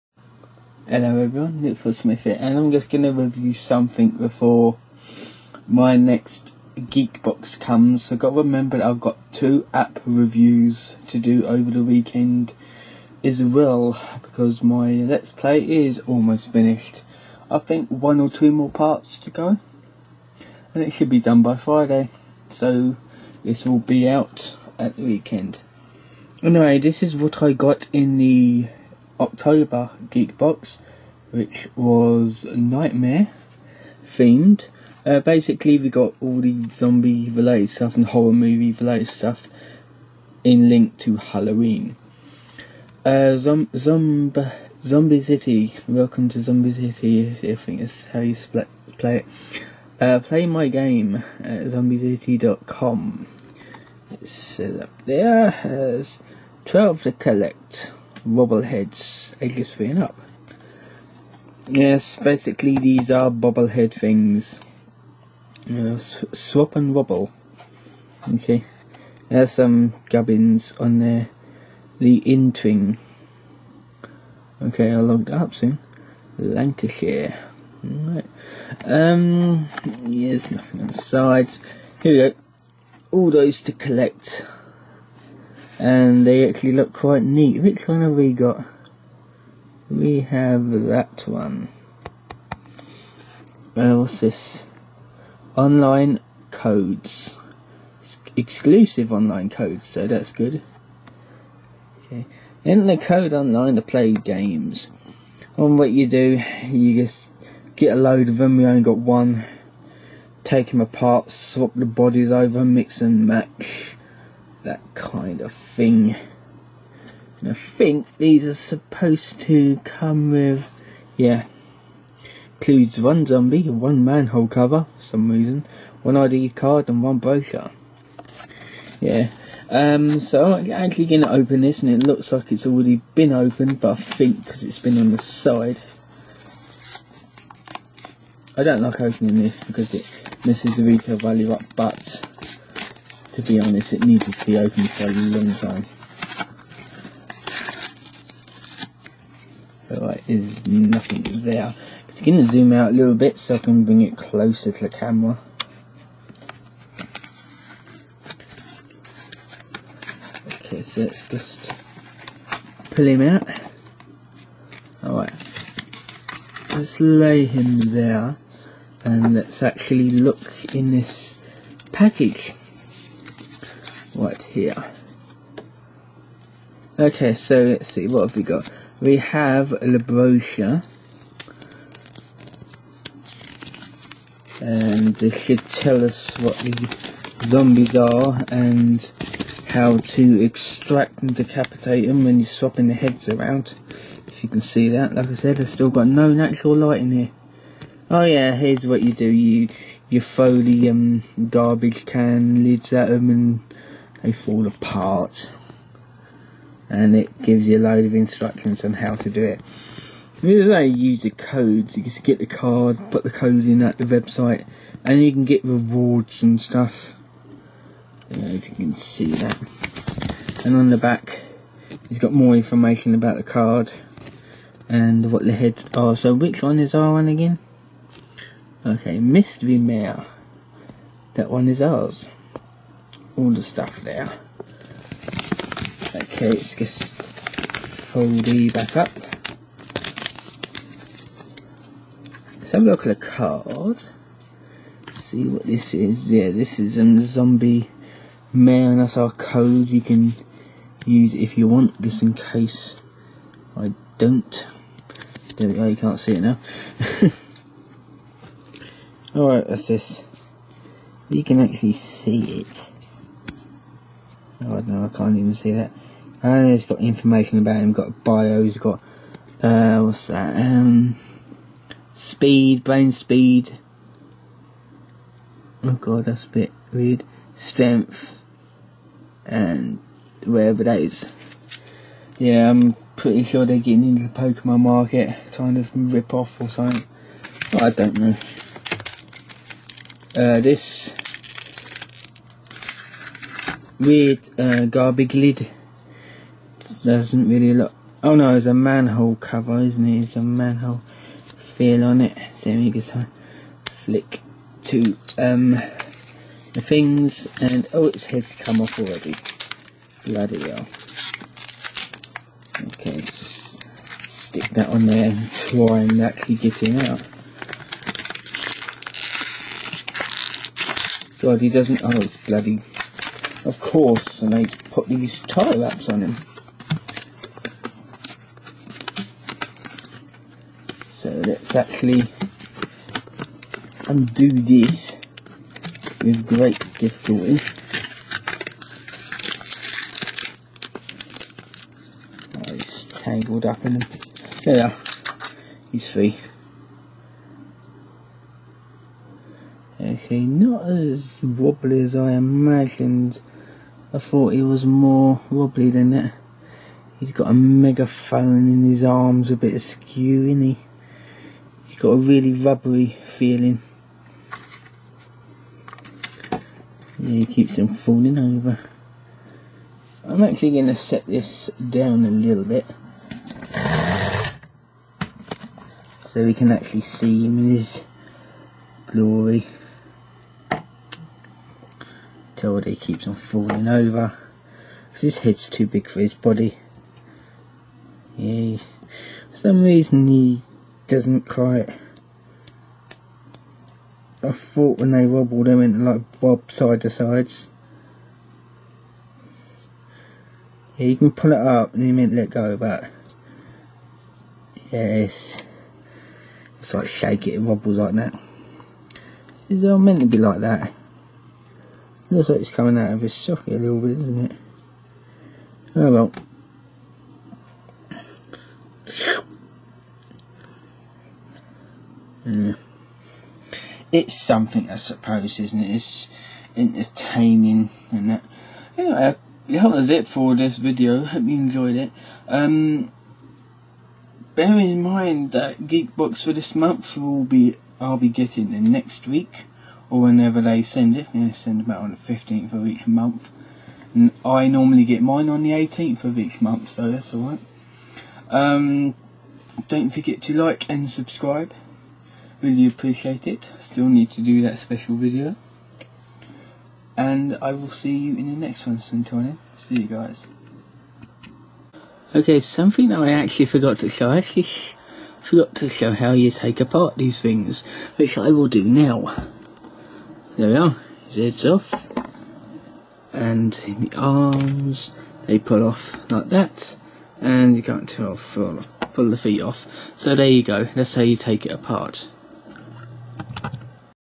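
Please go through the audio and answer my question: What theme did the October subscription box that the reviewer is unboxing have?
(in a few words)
Nightmare.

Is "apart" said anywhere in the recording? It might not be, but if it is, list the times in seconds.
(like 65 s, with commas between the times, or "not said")
110 s, 204 s, 466 s, 481 s.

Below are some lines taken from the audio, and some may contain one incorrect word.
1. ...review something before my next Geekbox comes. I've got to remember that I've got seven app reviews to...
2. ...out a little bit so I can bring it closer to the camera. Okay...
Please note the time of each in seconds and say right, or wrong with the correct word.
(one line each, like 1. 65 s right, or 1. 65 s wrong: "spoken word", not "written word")
1. 3 s wrong: "two", not "seven"
2. 152 s right.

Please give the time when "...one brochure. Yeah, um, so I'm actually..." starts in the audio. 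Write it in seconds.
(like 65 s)
127 s.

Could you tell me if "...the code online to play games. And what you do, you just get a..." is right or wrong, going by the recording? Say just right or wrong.
right.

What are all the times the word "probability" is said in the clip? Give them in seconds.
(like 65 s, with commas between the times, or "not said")
not said.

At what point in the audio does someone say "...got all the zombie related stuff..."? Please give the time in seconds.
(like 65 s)
35 s.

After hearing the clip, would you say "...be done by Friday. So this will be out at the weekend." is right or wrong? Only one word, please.
right.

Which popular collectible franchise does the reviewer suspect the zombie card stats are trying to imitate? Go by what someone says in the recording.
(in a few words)
Pokemon.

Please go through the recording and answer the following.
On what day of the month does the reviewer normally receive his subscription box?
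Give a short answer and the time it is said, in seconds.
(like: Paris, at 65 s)
18th, at 445 s.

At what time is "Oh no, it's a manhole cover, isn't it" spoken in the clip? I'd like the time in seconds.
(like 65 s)
298 s.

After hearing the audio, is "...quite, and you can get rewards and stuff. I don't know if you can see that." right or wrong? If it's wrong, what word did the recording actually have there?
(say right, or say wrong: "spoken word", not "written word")
wrong: "website", not "quite".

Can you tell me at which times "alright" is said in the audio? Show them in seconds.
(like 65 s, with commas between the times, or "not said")
165 s, 259 s, 447 s.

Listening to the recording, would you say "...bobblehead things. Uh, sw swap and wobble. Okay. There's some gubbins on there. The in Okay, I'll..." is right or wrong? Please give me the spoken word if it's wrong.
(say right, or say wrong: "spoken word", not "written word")
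right.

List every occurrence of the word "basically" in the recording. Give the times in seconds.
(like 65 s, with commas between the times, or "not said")
35 s, 62 s.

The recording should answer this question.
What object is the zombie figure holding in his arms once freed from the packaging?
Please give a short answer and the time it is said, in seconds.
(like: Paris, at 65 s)
megaphone, at 357 s.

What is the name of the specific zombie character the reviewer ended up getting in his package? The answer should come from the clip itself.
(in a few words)
Mystery Mayor.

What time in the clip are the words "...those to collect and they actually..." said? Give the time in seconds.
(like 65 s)
83 s.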